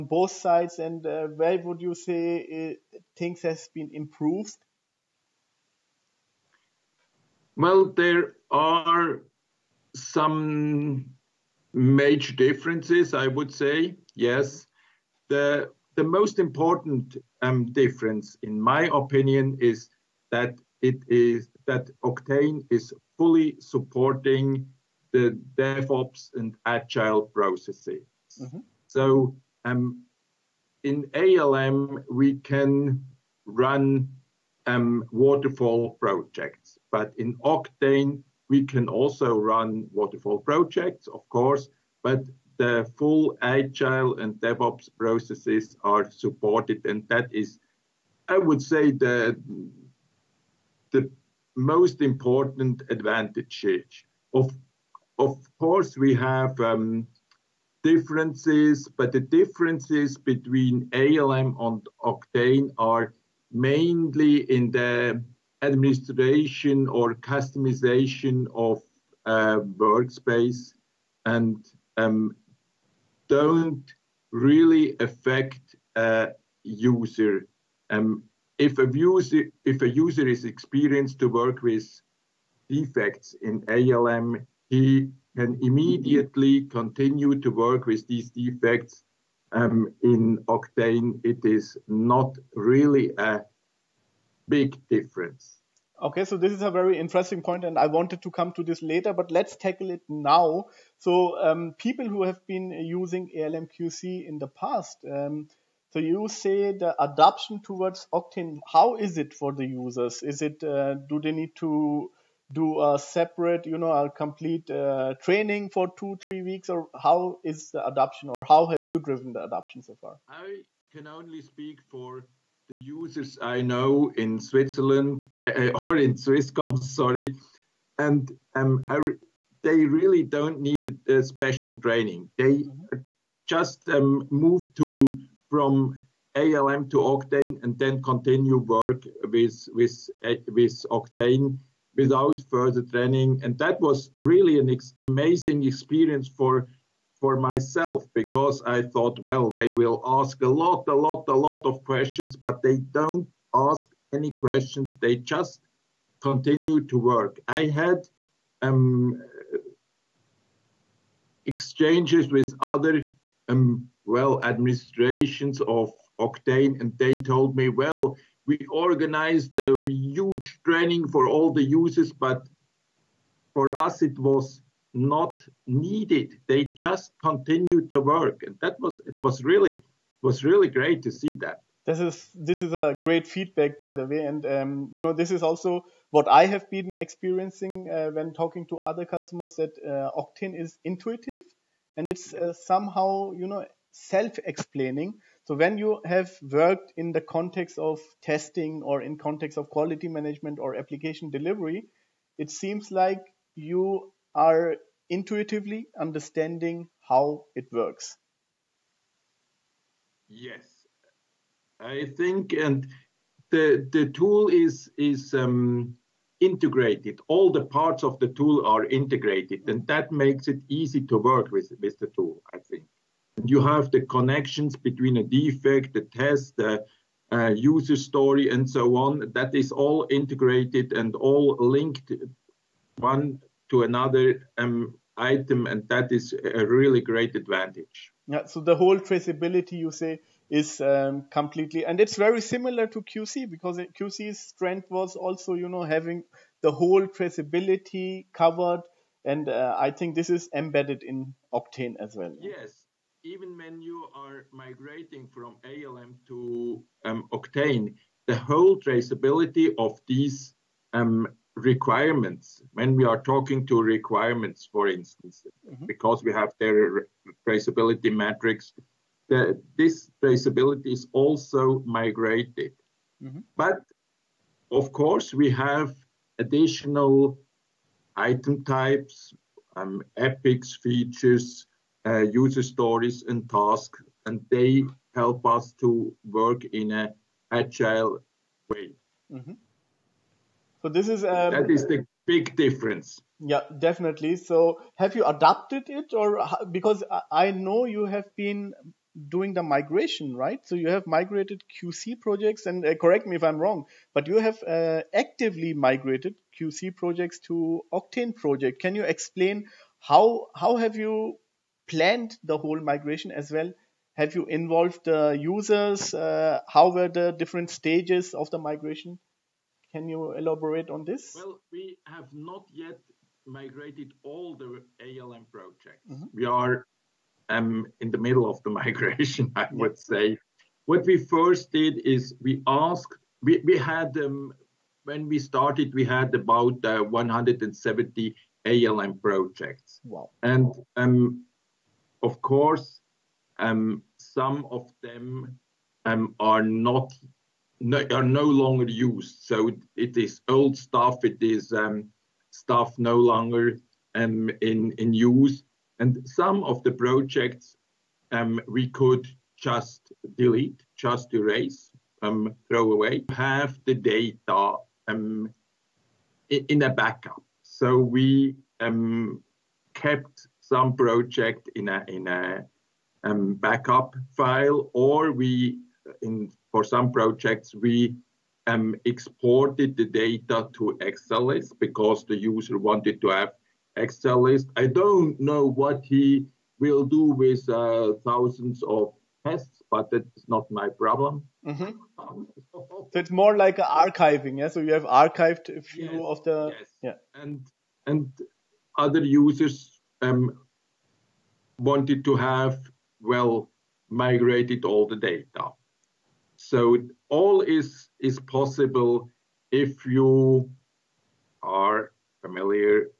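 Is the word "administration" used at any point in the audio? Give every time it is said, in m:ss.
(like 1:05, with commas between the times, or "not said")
1:05, 2:44.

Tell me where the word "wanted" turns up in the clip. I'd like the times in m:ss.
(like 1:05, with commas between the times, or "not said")
1:37, 6:22, 6:41.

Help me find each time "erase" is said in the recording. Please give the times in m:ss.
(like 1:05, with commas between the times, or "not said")
6:01.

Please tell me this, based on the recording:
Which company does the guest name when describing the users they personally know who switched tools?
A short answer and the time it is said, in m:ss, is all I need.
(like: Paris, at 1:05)
Swisscom, at 2:06.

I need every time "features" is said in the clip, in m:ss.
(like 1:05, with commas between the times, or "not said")
4:40.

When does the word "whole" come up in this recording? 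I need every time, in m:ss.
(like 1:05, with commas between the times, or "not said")
3:58, 4:06, 4:18, 5:12.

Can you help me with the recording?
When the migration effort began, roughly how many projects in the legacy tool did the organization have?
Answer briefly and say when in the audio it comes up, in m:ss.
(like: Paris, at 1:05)
170, at 5:37.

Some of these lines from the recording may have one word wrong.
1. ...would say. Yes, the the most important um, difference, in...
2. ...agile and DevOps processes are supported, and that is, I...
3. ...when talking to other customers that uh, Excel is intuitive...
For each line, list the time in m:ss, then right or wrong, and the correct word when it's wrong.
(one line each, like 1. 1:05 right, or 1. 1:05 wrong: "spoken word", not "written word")
1. 0:13 right
2. 0:43 right
3. 3:08 wrong: "Octane", not "Excel".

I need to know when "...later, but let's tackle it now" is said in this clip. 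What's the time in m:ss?
1:38.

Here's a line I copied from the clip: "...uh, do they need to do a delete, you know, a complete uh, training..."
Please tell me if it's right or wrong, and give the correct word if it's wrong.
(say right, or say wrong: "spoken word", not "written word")
wrong: "separate", not "delete".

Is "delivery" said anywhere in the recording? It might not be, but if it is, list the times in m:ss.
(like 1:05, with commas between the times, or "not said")
3:21.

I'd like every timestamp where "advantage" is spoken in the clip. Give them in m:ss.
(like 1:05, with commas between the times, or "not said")
0:52, 3:57.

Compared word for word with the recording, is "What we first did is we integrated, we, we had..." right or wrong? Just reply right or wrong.
wrong.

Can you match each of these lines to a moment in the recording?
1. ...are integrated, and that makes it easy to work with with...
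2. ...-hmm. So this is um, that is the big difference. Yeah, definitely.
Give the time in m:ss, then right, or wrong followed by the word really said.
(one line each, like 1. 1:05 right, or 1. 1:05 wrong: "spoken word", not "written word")
1. 3:38 right
2. 4:49 right.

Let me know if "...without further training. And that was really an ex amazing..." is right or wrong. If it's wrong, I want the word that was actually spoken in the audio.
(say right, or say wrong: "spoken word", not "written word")
right.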